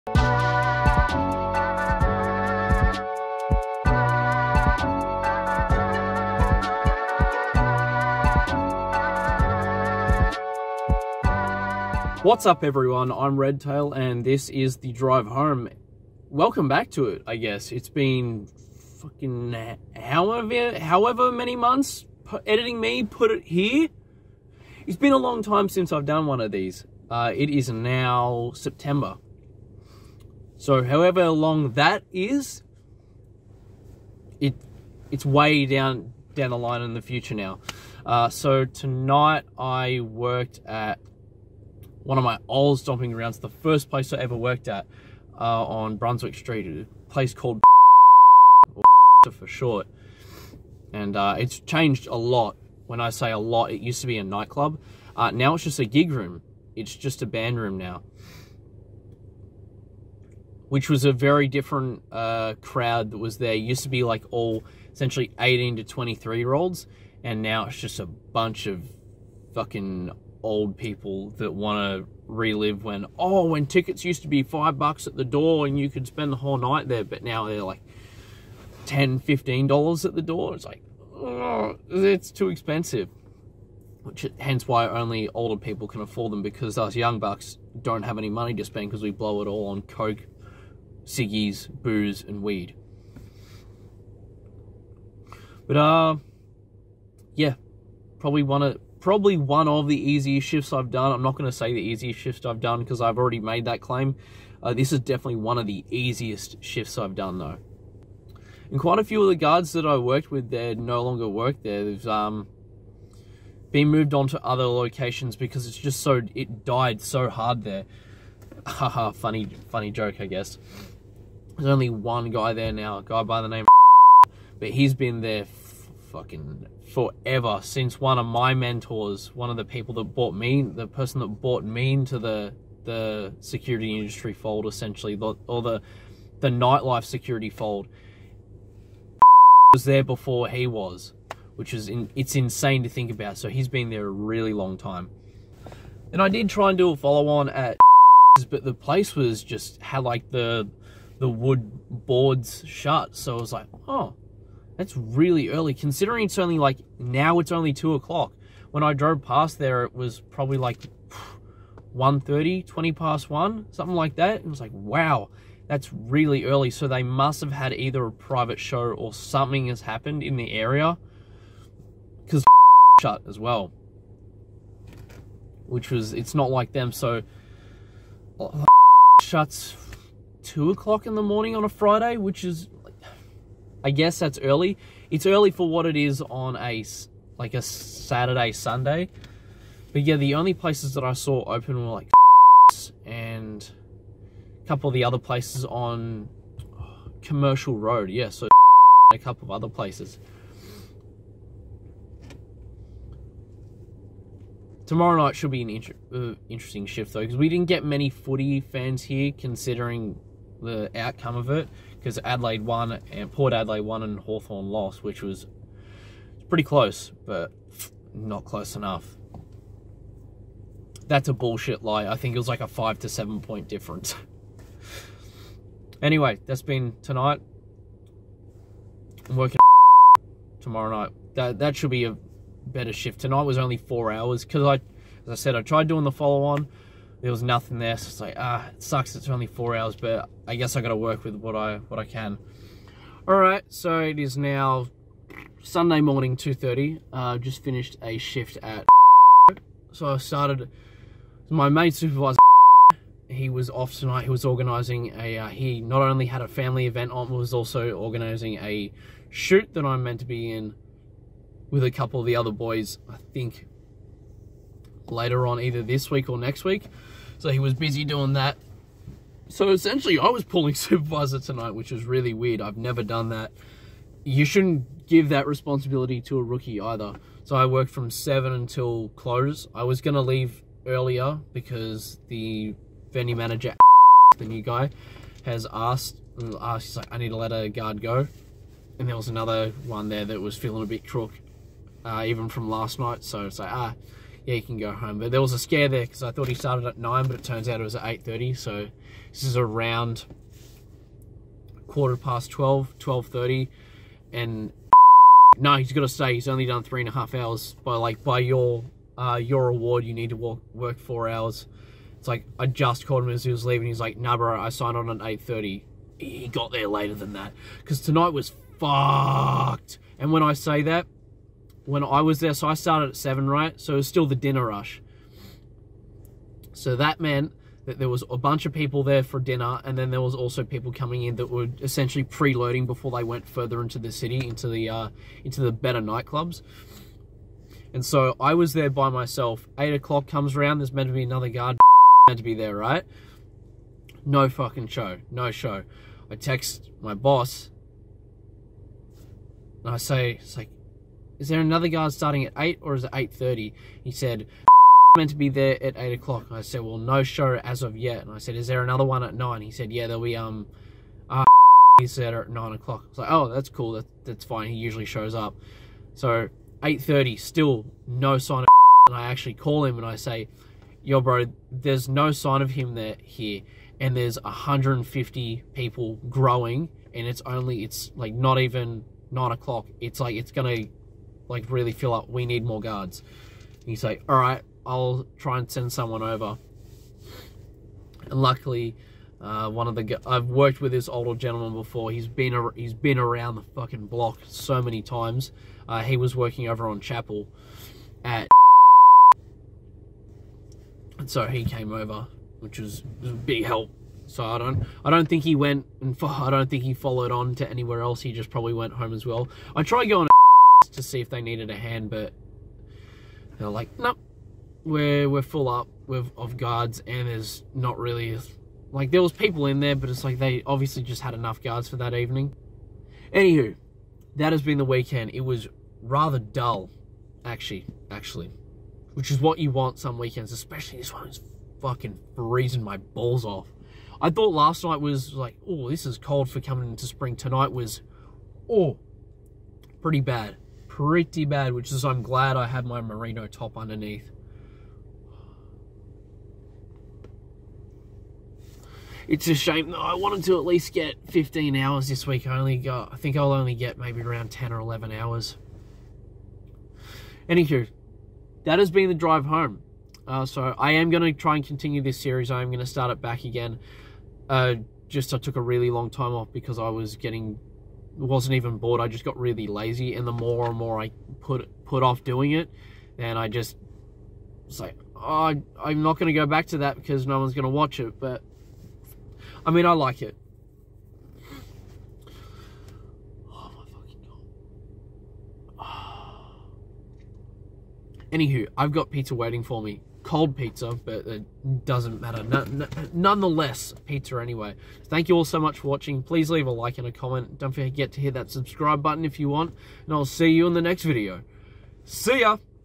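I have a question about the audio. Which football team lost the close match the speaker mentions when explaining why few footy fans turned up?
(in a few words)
Hawthorn.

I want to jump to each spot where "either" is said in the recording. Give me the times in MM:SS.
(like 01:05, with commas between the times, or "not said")
02:47, 04:25, 04:36.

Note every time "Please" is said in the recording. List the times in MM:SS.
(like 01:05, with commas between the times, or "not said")
08:16.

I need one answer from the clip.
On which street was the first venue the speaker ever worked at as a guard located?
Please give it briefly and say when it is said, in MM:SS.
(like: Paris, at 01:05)
Brunswick Street, at 00:45.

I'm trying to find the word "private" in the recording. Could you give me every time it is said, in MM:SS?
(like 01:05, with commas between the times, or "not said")
02:48.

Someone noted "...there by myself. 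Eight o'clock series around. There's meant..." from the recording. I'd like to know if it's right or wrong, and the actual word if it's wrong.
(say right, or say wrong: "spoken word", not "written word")
wrong: "comes", not "series".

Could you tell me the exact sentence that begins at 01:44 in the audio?
Uh, this is definitely one of the easiest shifts I've done though.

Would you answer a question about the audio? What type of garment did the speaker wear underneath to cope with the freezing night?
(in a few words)
merino top.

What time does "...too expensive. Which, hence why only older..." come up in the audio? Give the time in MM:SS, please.
01:22.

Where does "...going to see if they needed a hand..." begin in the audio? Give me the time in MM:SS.
06:50.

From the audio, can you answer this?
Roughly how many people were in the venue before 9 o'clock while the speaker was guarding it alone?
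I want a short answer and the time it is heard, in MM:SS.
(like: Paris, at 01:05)
150, at 06:14.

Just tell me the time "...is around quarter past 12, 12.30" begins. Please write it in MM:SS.
04:59.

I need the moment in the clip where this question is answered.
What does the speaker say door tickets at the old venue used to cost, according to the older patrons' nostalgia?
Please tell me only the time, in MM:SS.
01:14.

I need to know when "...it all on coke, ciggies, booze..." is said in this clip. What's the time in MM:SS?
01:29.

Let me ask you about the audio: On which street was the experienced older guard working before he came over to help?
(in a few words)
Chapel.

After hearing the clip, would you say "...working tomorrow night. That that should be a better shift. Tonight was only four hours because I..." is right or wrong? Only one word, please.
right.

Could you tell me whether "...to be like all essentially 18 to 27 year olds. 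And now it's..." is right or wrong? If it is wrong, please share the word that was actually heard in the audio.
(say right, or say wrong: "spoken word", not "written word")
wrong: "23", not "27".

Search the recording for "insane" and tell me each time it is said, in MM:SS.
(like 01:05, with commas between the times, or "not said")
02:22.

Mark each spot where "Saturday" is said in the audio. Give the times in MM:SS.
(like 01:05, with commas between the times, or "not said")
03:07.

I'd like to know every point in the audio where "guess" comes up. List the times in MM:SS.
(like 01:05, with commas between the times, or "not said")
00:17, 02:00, 03:03, 04:00.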